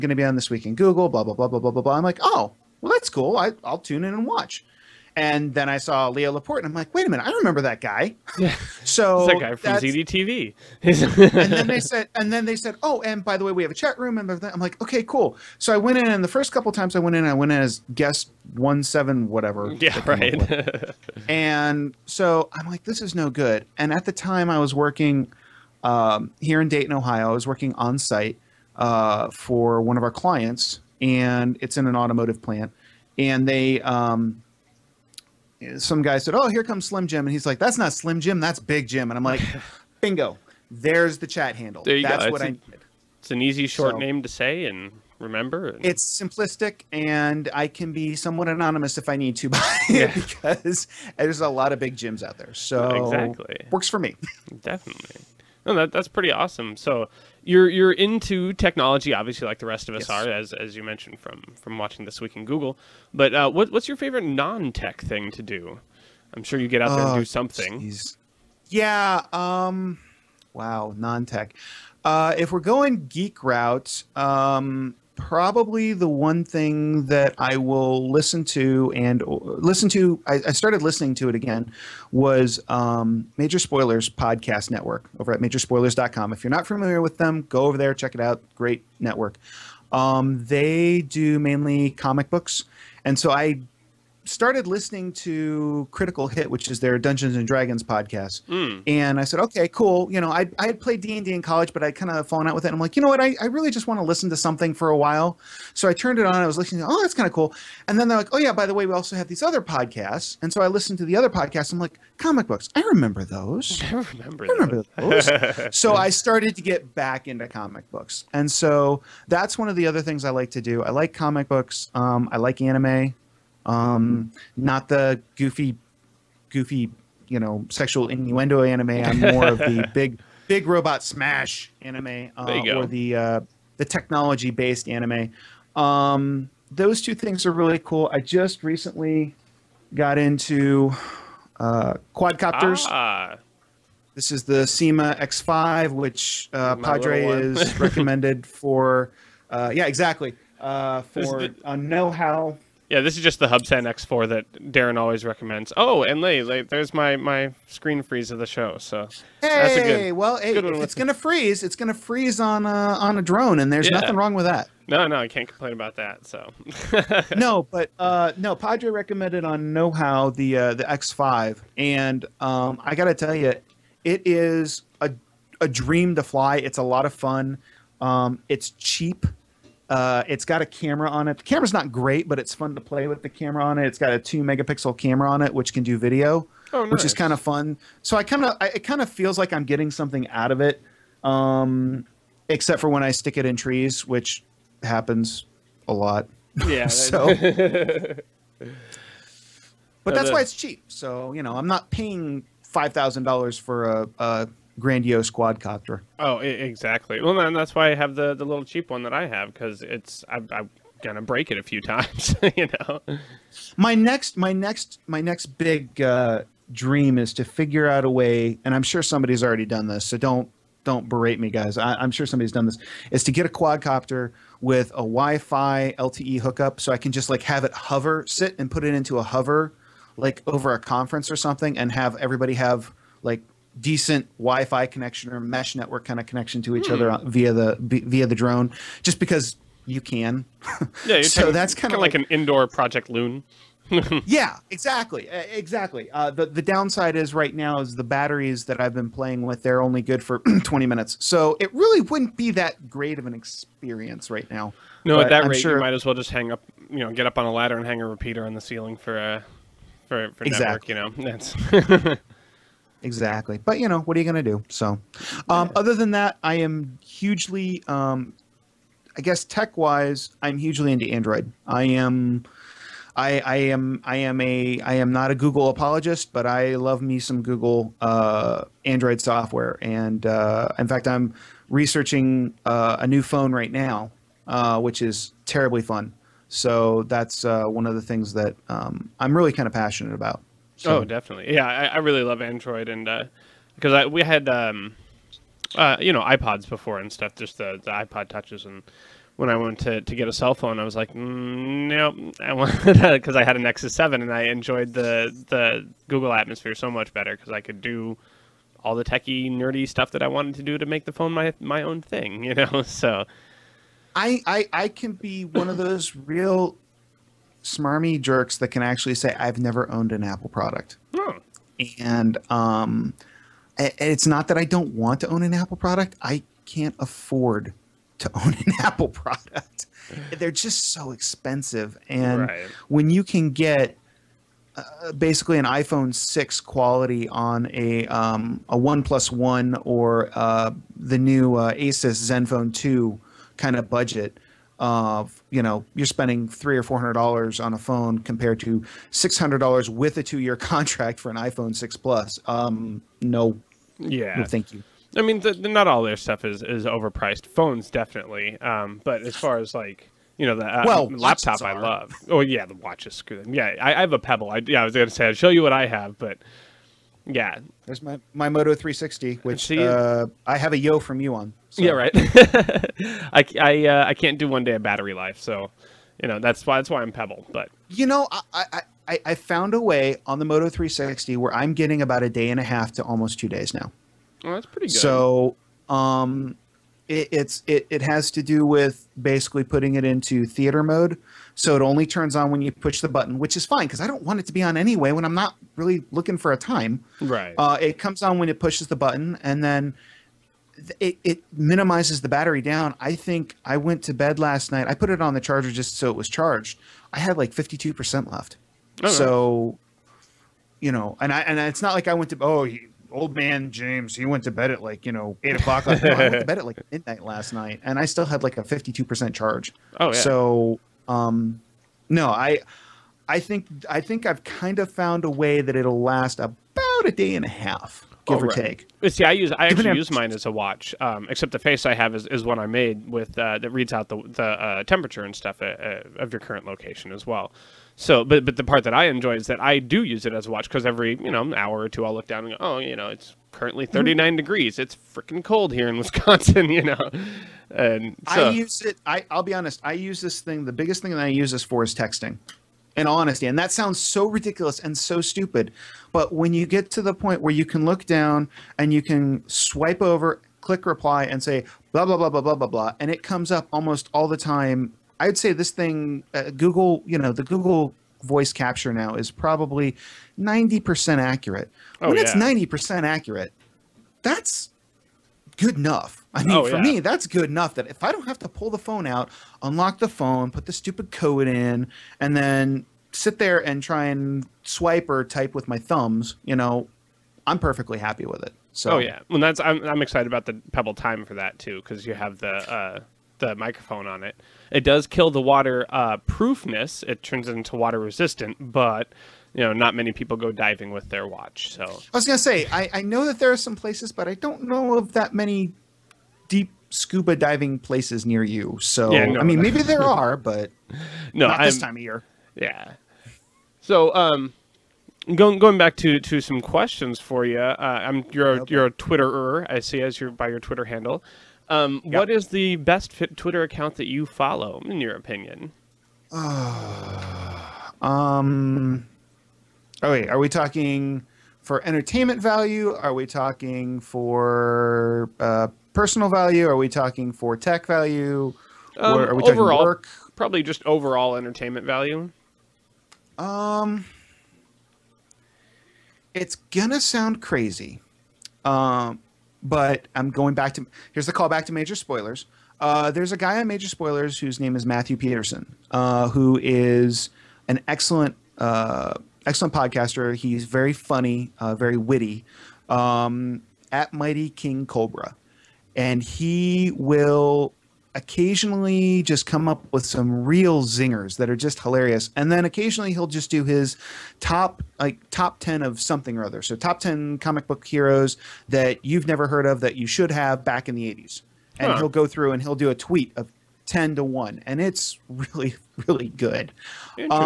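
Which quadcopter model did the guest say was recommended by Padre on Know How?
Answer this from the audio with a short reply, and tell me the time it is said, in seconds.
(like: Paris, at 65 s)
Syma X5, at 144 s.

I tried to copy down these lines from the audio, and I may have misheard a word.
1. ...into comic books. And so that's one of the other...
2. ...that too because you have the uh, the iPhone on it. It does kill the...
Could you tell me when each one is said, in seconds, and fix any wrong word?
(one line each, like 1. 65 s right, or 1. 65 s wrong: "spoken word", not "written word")
1. 117 s right
2. 491 s wrong: "microphone", not "iPhone".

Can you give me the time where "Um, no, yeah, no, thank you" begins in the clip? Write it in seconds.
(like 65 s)
352 s.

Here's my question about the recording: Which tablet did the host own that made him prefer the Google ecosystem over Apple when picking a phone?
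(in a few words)
Nexus Seven.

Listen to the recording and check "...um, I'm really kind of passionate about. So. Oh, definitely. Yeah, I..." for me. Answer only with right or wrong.
right.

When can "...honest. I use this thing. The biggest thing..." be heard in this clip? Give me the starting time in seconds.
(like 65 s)
449 s.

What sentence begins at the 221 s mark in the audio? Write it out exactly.
I, am sure somebody's done this.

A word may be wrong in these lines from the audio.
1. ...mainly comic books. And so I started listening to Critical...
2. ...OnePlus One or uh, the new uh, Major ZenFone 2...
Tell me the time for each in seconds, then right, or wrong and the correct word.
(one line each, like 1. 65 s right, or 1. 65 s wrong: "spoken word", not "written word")
1. 91 s right
2. 338 s wrong: "Asus", not "Major".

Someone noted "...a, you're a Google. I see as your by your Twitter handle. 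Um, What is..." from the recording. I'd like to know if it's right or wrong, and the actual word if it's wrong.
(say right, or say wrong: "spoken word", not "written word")
wrong: "Twitterer", not "Google".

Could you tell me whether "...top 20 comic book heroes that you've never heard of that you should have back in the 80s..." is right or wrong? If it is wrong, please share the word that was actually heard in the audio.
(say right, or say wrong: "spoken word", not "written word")
wrong: "10", not "20".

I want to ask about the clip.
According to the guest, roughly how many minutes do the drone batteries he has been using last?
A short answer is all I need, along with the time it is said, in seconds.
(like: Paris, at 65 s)
20, at 250 s.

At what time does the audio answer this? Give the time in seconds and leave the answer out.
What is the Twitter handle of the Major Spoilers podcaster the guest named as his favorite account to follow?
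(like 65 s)
564 s.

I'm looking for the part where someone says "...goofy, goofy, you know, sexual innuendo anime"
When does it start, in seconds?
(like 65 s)
125 s.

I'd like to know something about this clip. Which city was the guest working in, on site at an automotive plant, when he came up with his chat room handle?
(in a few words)
Dayton, Ohio.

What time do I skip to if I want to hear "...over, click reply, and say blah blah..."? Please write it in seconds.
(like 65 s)
460 s.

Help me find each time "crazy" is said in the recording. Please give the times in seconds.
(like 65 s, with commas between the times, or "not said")
547 s.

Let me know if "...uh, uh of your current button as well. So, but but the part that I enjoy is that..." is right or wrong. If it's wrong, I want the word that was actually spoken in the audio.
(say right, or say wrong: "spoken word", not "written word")
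wrong: "location", not "button".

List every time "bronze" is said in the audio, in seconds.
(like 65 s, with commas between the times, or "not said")
not said.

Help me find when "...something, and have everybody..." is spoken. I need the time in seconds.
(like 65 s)
231 s.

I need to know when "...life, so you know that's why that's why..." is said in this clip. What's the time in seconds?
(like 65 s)
375 s.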